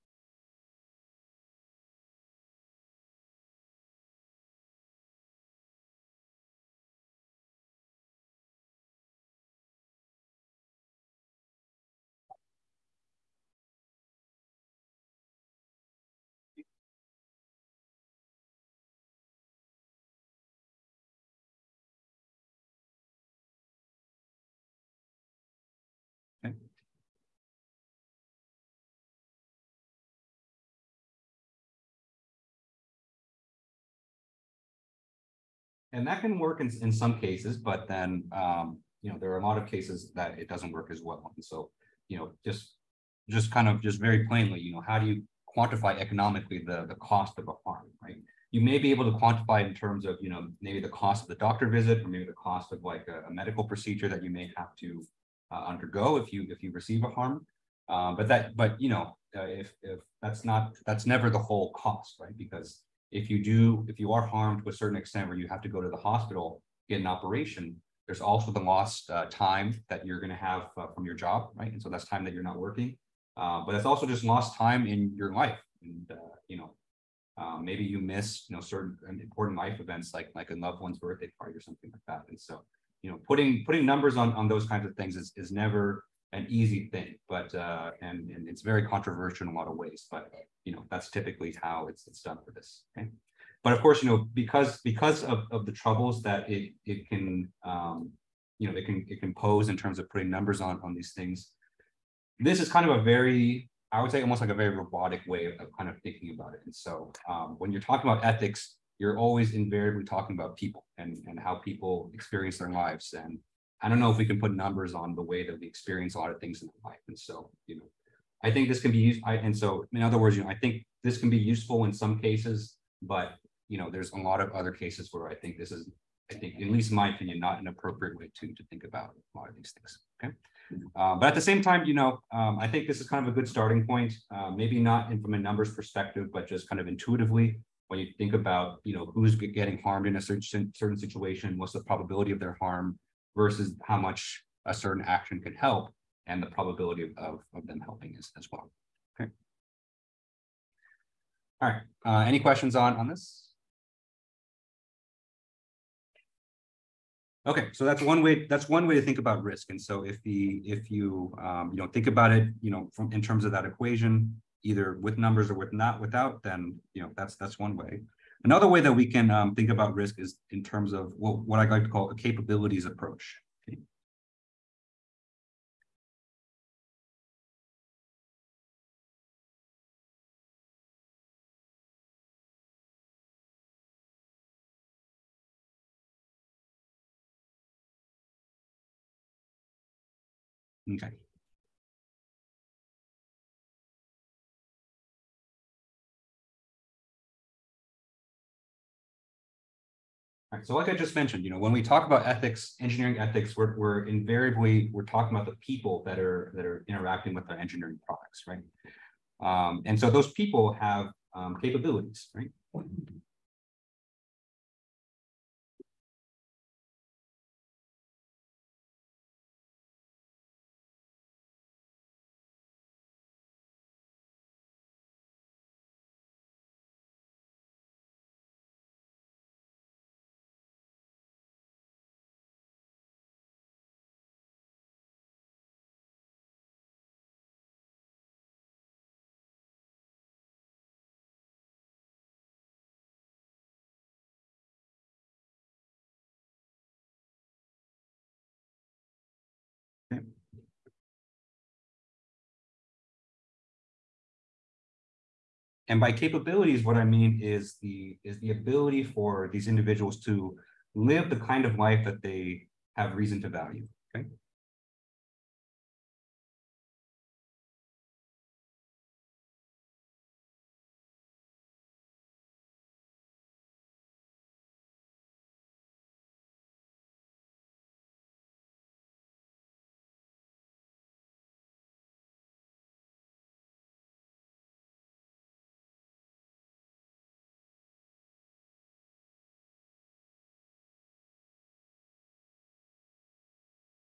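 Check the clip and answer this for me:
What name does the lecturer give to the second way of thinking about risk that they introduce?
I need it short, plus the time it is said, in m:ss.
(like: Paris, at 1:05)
Capabilities approach, at 2:52.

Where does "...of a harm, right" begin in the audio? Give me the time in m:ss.
0:47.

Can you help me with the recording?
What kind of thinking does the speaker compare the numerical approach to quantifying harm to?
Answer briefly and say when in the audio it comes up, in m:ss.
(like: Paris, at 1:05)
Robotic, at 1:44.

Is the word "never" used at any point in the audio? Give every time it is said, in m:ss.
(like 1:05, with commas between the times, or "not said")
1:01, 1:25.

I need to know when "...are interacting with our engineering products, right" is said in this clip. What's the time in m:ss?
3:26.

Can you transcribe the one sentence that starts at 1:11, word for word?
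And so that's time that you're not working.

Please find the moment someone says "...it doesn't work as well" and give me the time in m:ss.
0:40.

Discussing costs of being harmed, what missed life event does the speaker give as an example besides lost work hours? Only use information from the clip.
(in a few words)
A loved one's birthday party.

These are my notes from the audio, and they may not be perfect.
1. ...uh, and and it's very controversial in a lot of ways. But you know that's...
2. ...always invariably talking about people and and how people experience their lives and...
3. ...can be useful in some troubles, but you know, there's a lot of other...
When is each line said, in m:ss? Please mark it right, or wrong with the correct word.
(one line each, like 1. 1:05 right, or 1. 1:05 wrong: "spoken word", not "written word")
1. 1:27 right
2. 1:49 right
3. 2:01 wrong: "cases", not "troubles".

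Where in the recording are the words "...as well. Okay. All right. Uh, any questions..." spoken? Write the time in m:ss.
2:28.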